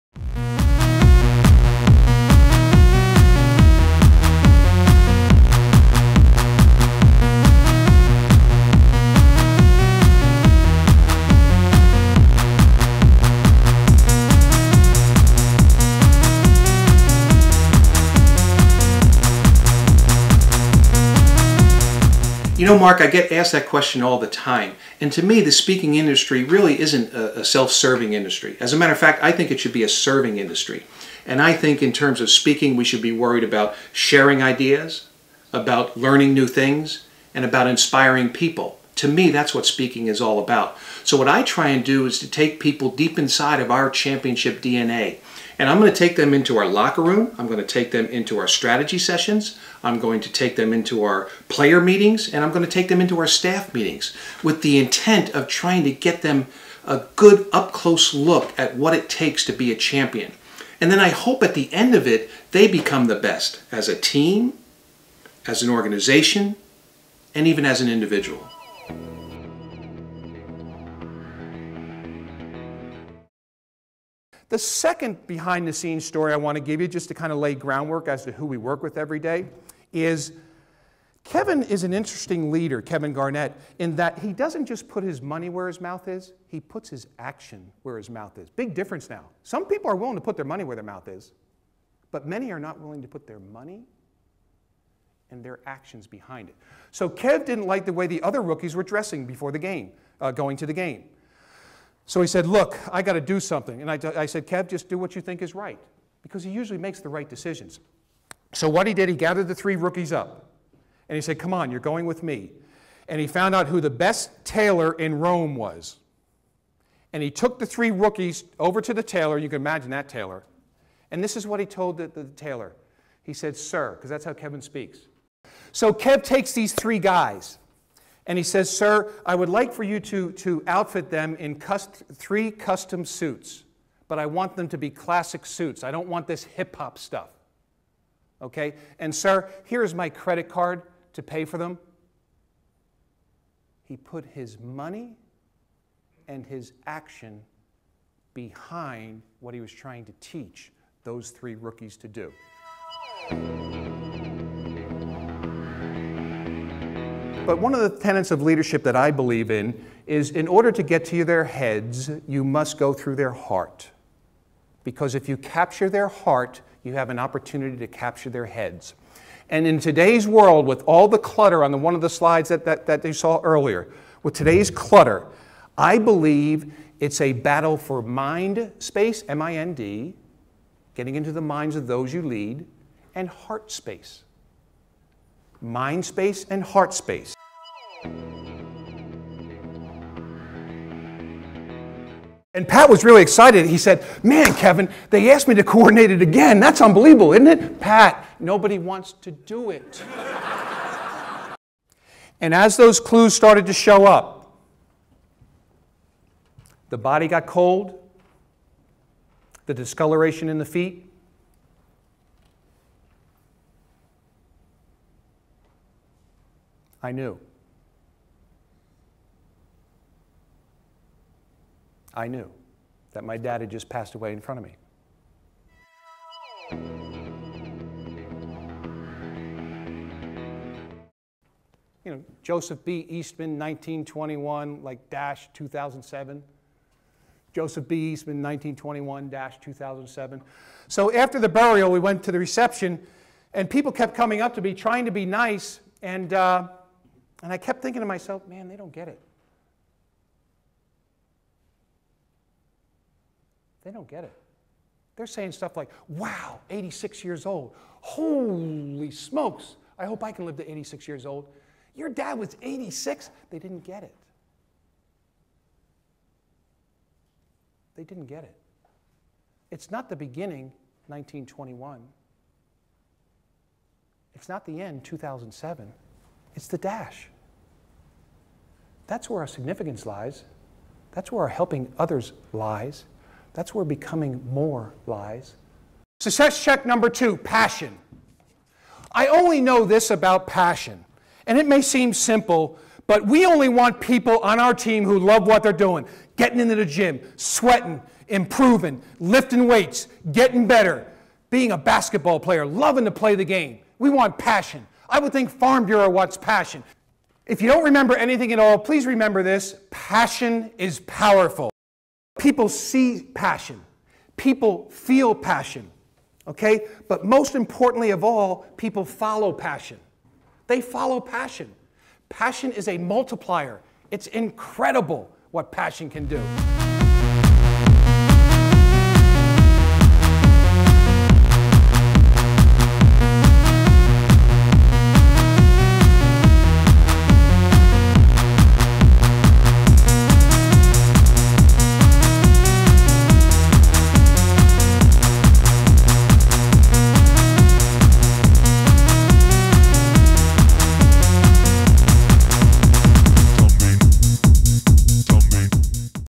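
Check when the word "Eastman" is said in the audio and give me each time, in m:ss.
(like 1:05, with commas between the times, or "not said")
3:53, 3:58.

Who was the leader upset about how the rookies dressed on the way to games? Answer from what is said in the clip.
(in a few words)
Kevin Garnett.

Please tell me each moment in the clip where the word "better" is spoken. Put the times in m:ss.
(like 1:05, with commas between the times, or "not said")
5:00.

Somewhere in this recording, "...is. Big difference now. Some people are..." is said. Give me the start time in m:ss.
1:28.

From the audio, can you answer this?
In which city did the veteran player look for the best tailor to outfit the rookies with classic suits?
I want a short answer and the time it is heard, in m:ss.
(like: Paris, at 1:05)
Rome, at 1:55.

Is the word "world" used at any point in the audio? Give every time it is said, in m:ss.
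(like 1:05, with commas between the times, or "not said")
2:50.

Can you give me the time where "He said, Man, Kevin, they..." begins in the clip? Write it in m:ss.
3:13.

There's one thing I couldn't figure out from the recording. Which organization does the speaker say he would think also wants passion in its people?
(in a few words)
Farm Bureau.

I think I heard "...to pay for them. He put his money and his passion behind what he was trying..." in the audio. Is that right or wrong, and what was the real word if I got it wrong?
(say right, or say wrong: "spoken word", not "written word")
wrong: "action", not "passion".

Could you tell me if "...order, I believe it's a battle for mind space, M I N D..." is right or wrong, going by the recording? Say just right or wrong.
wrong.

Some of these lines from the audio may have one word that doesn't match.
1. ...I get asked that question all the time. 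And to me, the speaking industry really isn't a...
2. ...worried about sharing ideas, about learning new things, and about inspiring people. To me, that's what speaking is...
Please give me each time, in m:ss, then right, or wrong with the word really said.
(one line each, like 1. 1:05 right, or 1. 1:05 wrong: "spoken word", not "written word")
1. 0:23 right
2. 0:33 right.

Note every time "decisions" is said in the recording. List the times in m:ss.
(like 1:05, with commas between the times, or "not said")
1:47.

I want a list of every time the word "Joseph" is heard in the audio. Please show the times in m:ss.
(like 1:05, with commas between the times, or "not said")
3:52, 3:57.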